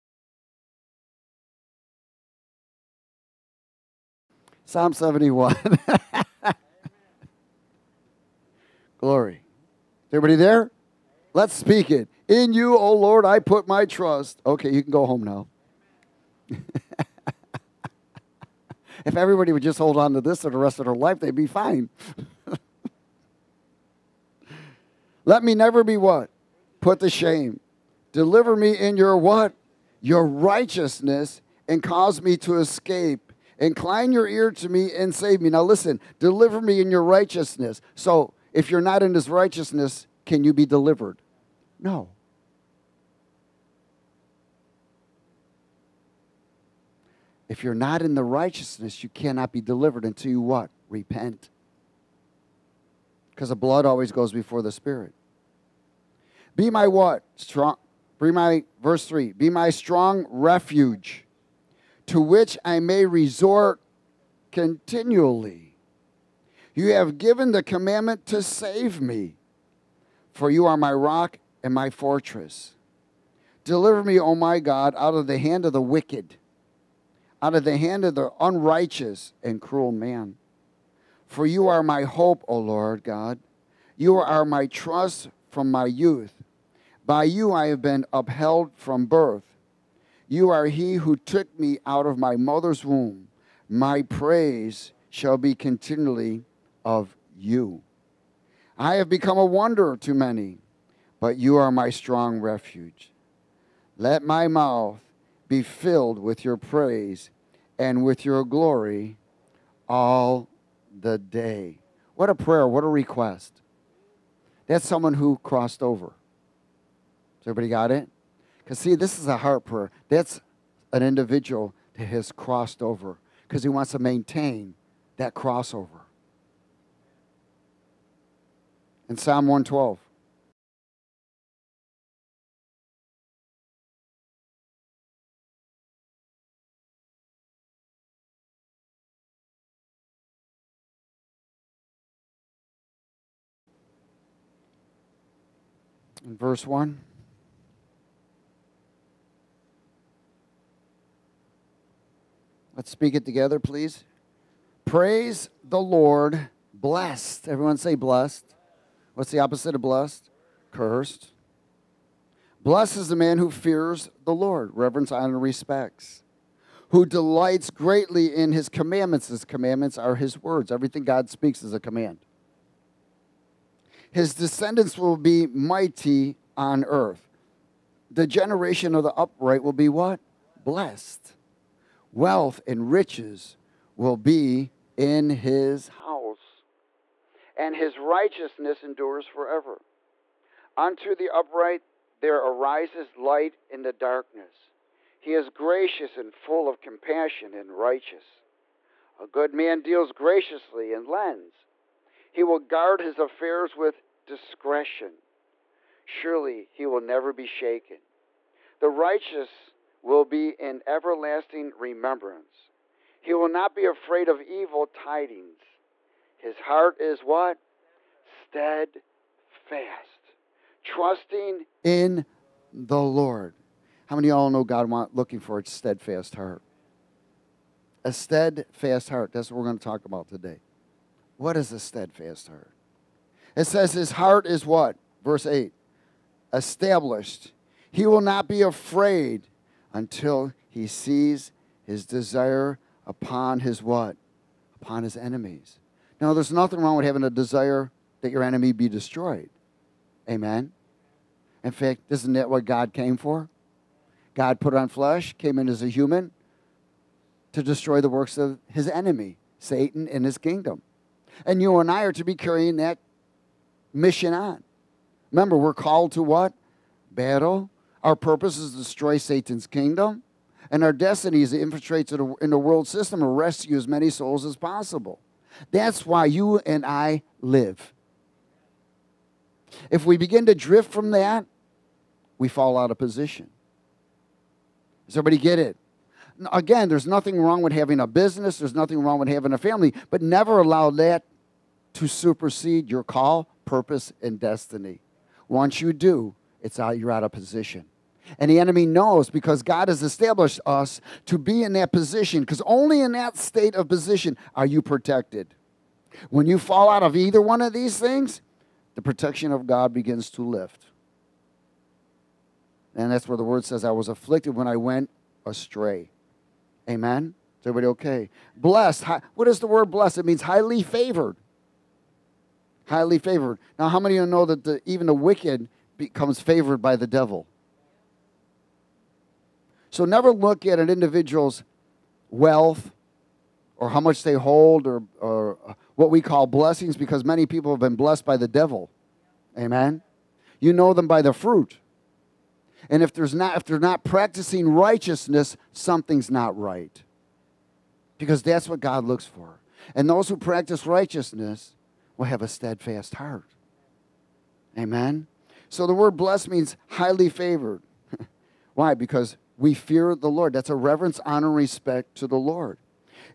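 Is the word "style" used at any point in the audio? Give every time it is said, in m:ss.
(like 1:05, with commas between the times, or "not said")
not said.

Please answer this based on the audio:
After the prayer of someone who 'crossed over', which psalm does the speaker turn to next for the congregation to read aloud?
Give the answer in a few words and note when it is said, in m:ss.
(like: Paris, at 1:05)
Psalm 112, at 2:09.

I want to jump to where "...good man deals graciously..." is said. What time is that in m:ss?
3:19.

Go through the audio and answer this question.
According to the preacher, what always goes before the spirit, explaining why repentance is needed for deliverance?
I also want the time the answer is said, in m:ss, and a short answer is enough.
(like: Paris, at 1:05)
The blood, at 0:53.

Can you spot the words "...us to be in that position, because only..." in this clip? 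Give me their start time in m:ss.
5:00.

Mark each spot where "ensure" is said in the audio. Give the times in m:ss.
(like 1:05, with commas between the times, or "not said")
not said.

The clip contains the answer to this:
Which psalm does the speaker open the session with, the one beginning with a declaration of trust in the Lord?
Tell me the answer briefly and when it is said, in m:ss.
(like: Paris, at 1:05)
Psalm 71, at 0:04.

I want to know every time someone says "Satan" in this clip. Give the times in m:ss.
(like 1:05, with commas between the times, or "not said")
4:19, 4:29.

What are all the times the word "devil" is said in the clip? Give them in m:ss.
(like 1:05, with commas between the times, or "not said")
5:27, 5:38.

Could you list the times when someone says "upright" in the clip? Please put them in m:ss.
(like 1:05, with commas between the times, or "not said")
2:59, 3:11.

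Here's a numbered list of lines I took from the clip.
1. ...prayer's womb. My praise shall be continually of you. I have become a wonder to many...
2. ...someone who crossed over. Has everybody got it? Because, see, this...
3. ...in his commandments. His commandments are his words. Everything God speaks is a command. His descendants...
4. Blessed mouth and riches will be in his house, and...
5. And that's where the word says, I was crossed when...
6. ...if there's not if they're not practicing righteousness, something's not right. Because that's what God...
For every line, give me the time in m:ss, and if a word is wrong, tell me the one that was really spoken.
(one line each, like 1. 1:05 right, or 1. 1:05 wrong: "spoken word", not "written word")
1. 1:32 wrong: "mother", not "prayer"
2. 1:54 right
3. 2:48 right
4. 3:00 wrong: "wealth", not "mouth"
5. 5:12 wrong: "afflicted", not "crossed"
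6. 5:43 right.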